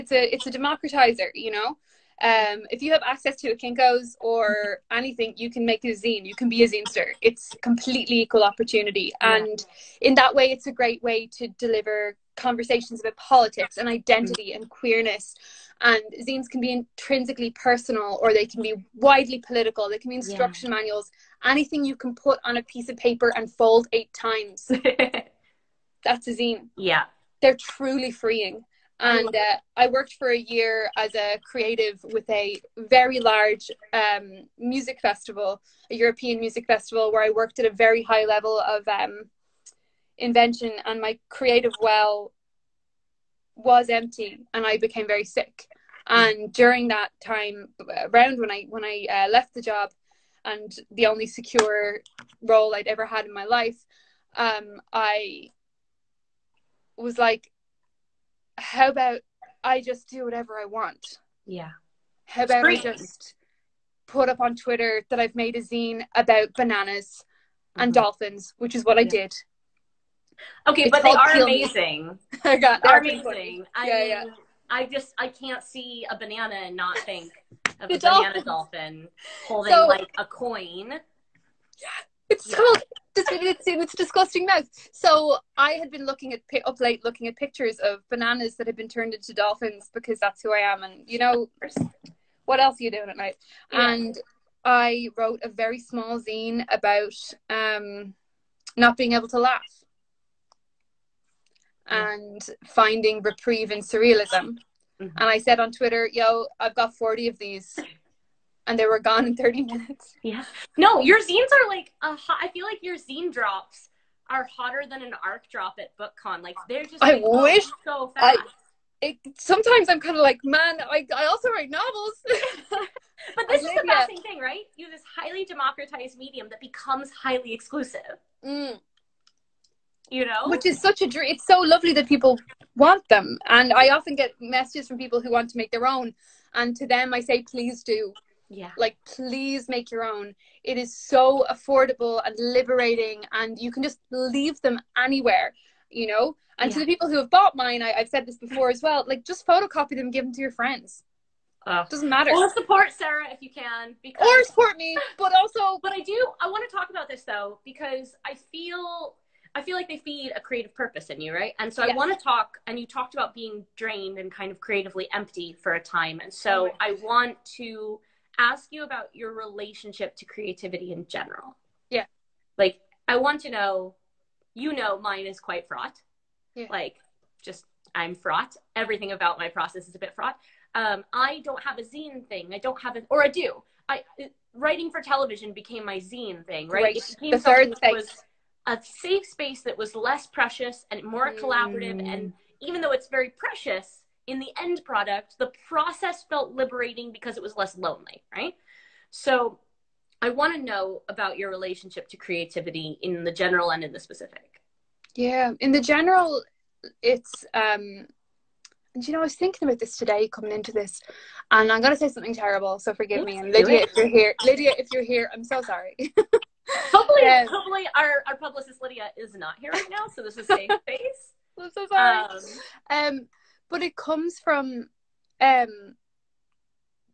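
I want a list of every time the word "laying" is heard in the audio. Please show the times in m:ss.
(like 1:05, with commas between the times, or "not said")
not said.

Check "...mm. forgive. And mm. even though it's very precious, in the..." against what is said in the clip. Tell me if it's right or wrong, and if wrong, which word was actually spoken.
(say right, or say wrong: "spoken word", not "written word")
wrong: "collaborative", not "forgive".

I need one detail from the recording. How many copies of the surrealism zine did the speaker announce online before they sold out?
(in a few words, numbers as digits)
40.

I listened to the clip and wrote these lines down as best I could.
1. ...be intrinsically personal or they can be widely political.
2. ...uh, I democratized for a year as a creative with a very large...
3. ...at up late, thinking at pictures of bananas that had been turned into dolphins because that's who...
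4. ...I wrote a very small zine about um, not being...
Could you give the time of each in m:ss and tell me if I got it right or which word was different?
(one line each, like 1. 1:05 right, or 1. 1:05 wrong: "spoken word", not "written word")
1. 0:16 right
2. 0:29 wrong: "worked", not "democratized"
3. 1:26 wrong: "looking", not "thinking"
4. 1:34 right.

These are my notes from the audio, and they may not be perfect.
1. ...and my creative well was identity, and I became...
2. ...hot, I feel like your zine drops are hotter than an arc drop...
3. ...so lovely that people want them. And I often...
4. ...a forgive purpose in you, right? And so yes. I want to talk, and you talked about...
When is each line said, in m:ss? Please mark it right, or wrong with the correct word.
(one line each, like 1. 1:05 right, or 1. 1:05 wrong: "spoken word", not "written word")
1. 0:40 wrong: "empty", not "identity"
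2. 1:52 right
3. 2:11 right
4. 2:40 wrong: "creative", not "forgive".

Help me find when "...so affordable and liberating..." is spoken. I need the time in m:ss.
2:20.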